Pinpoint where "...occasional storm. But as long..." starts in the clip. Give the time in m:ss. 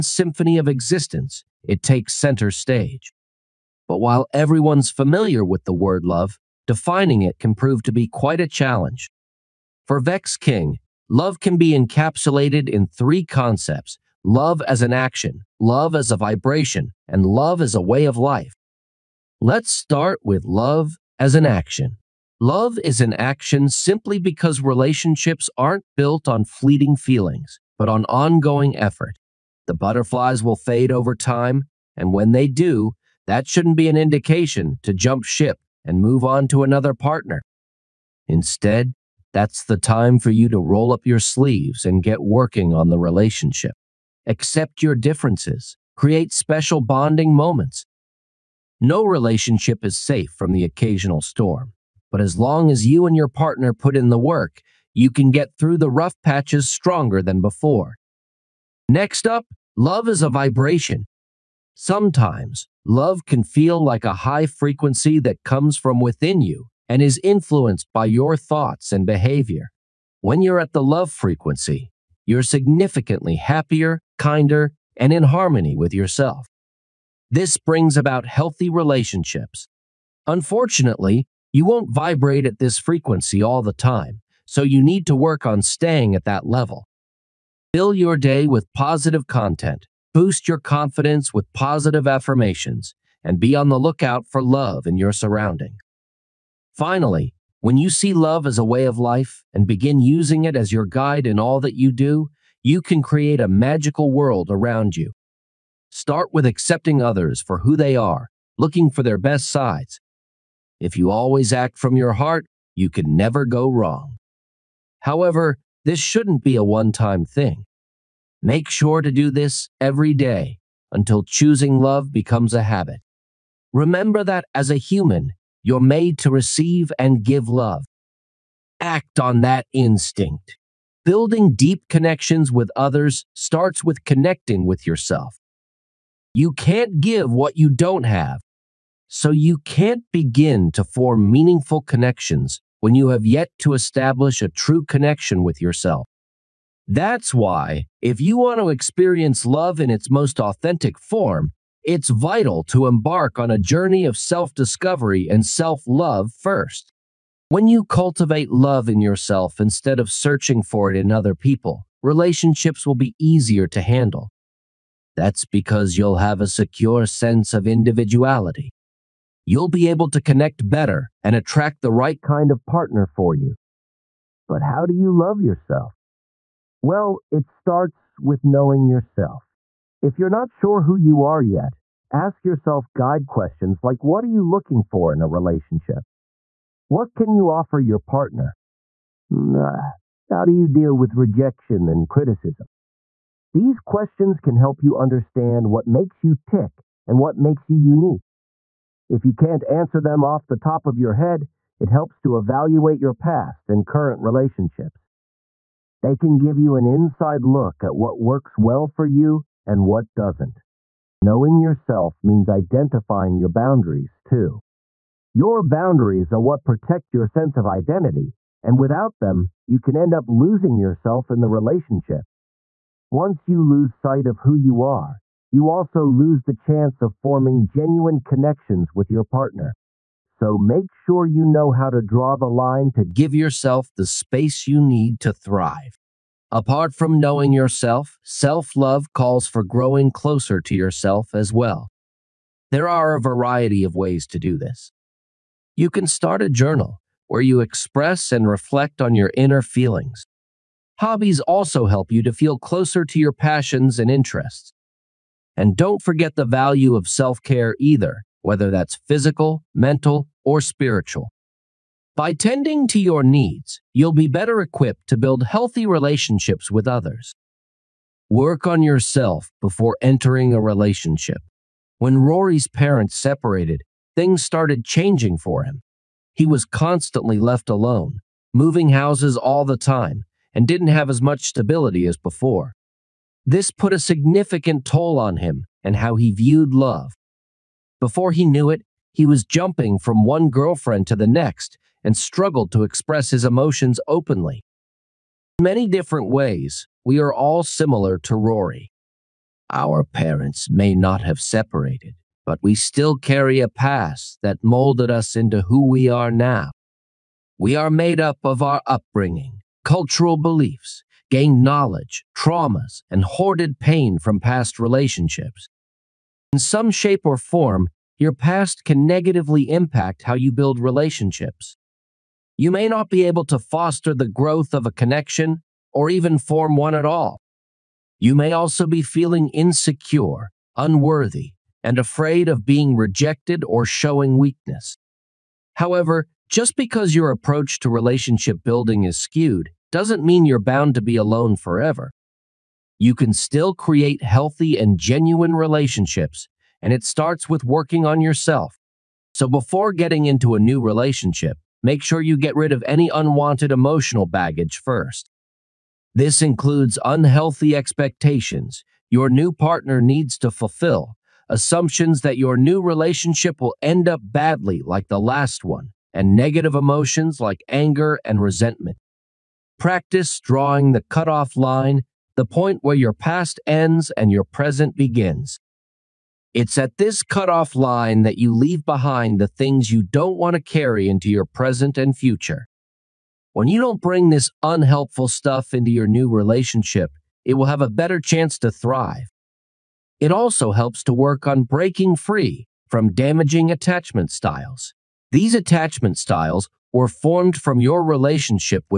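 0:50.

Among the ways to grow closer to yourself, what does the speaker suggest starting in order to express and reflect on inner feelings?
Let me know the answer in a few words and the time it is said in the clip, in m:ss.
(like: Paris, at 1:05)
A journal, at 4:06.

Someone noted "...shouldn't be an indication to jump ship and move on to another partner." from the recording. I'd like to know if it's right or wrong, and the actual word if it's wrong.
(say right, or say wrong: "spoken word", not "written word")
right.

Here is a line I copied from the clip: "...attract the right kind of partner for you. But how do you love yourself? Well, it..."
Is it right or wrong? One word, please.
right.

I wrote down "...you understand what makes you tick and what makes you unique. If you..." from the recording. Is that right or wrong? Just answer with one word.
right.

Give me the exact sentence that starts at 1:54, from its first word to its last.
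However, this shouldn't be a one time thing.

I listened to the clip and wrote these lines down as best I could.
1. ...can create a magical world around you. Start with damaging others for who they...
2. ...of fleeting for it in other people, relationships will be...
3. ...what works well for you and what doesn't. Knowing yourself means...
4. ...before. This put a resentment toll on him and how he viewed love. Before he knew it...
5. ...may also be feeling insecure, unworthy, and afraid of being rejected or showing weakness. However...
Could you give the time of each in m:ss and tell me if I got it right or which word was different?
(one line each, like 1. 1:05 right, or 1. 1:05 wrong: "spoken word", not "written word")
1. 1:42 wrong: "accepting", not "damaging"
2. 2:40 wrong: "searching", not "fleeting"
3. 3:27 right
4. 4:42 wrong: "significant", not "resentment"
5. 5:28 right.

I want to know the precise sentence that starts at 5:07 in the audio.
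We are made up of our upbringing, cultural beliefs, gained knowledge, traumas, and hoarded pain from past relationships.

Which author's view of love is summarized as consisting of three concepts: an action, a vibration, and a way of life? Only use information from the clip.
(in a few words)
Vex King.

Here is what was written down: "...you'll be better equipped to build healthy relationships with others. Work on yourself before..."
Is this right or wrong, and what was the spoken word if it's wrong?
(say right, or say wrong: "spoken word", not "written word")
right.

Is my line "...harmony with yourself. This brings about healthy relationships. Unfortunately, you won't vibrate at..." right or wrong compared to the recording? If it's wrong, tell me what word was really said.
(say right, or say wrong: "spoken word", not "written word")
right.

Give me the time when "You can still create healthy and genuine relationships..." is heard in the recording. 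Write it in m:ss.
5:42.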